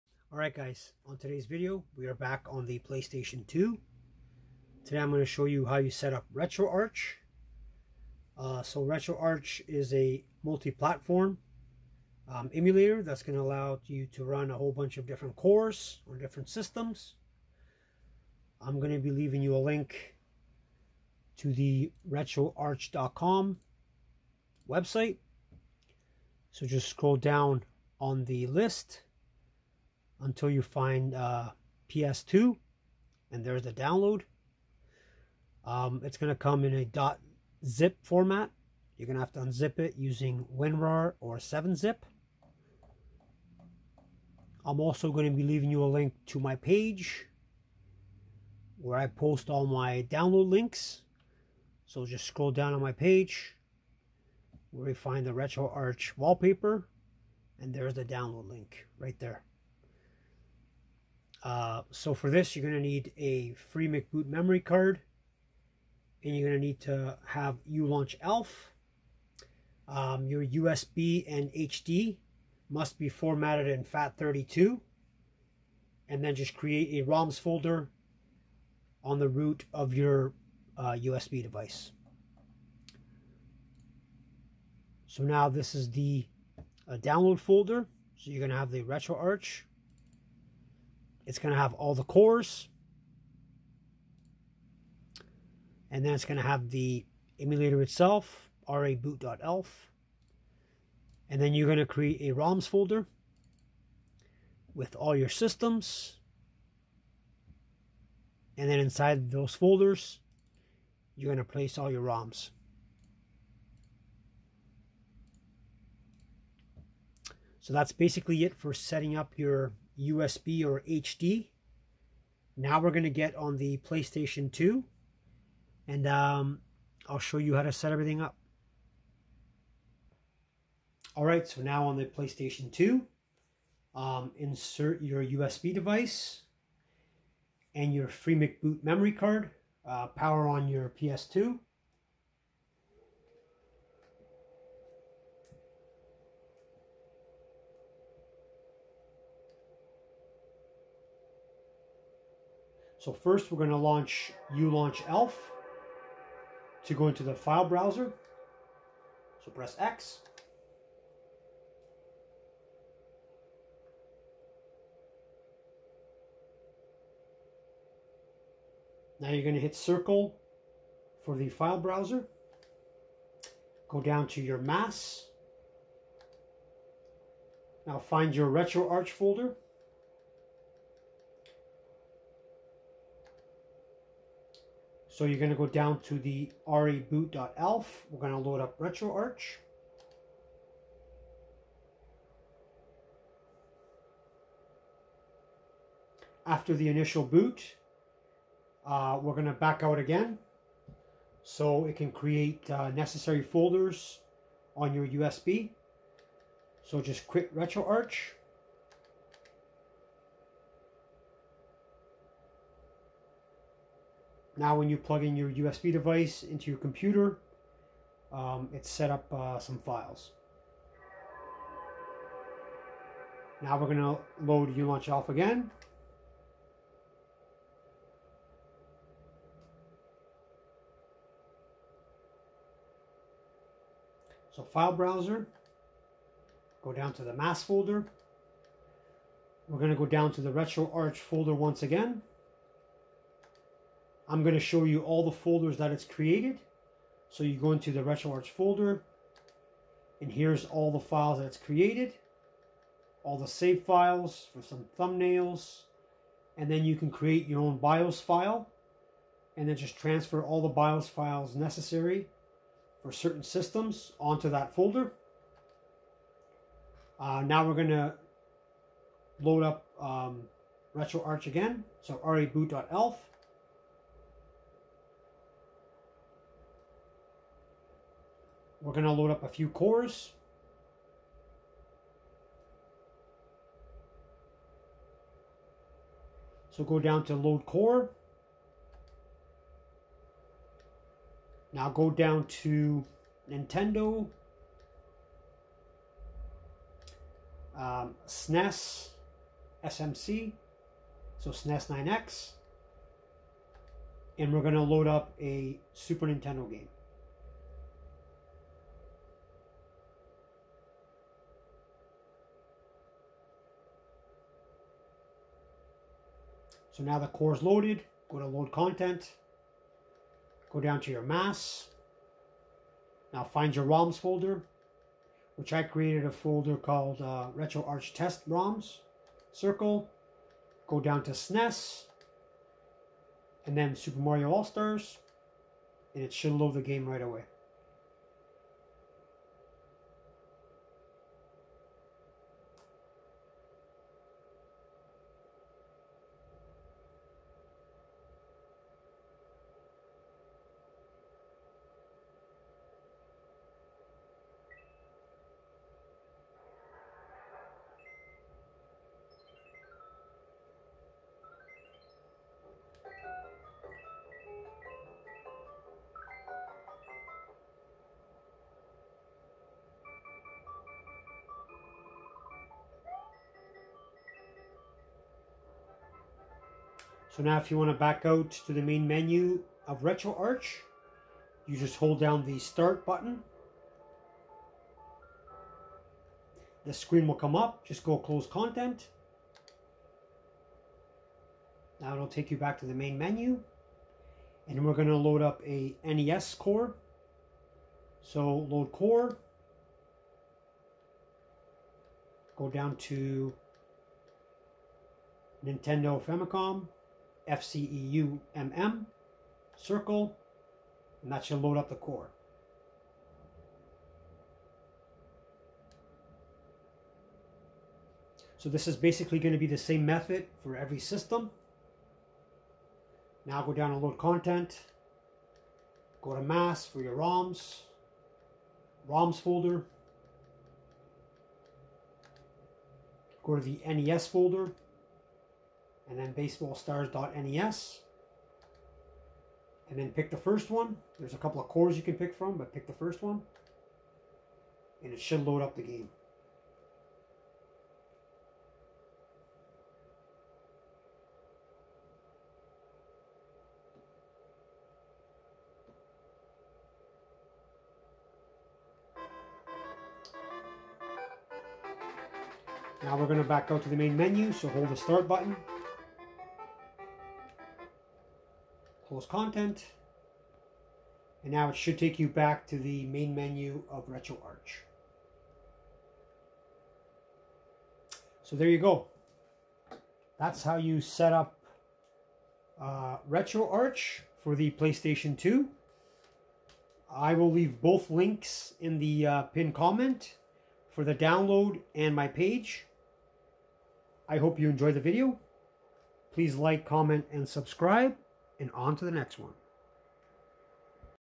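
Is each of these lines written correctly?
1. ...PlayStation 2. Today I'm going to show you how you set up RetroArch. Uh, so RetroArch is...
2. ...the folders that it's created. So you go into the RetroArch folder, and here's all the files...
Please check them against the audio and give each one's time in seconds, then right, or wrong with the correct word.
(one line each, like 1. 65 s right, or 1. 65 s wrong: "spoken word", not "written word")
1. 2 s right
2. 245 s right.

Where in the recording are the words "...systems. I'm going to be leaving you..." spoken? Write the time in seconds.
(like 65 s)
16 s.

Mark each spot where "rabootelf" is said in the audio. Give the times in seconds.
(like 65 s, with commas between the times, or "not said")
98 s, 186 s, 272 s.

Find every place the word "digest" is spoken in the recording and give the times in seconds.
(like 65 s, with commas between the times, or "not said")
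not said.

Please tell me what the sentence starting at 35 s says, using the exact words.
Um, it's going to come in a .zip format.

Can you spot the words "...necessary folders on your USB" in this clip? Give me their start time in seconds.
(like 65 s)
202 s.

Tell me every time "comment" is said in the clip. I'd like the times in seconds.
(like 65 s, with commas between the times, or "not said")
489 s, 496 s.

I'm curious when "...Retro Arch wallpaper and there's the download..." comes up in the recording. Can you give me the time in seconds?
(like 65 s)
55 s.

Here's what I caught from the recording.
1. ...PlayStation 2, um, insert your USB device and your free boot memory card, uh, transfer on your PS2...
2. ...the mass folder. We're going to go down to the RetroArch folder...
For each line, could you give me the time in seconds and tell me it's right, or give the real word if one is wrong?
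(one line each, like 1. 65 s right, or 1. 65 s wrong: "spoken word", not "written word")
1. 132 s wrong: "power", not "transfer"
2. 237 s right.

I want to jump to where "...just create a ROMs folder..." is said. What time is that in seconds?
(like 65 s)
76 s.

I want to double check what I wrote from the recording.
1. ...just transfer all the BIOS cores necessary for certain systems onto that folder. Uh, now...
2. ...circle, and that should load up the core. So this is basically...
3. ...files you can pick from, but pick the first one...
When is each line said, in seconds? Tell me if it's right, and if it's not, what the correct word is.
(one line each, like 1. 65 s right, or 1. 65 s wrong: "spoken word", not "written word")
1. 259 s wrong: "files", not "cores"
2. 409 s right
3. 441 s wrong: "cores", not "files".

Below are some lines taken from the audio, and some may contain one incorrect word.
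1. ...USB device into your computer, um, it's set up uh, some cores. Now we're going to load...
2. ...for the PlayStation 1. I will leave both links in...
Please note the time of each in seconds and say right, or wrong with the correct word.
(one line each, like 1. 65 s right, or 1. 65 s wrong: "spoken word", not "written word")
1. 215 s wrong: "files", not "cores"
2. 484 s wrong: "2", not "1".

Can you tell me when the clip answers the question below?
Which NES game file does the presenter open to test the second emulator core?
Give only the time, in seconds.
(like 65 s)
436 s.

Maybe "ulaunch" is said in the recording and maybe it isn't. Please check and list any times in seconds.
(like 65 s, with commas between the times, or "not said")
67 s, 154 s, 224 s.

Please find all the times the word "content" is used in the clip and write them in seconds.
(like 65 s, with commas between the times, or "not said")
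318 s, 388 s, 424 s, 469 s.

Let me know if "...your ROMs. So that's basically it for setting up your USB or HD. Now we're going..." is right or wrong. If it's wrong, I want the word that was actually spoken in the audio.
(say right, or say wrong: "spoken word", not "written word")
right.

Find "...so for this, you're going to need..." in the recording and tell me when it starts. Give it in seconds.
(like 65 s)
61 s.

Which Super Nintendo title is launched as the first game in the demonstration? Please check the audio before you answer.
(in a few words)
Super Mario All-Stars.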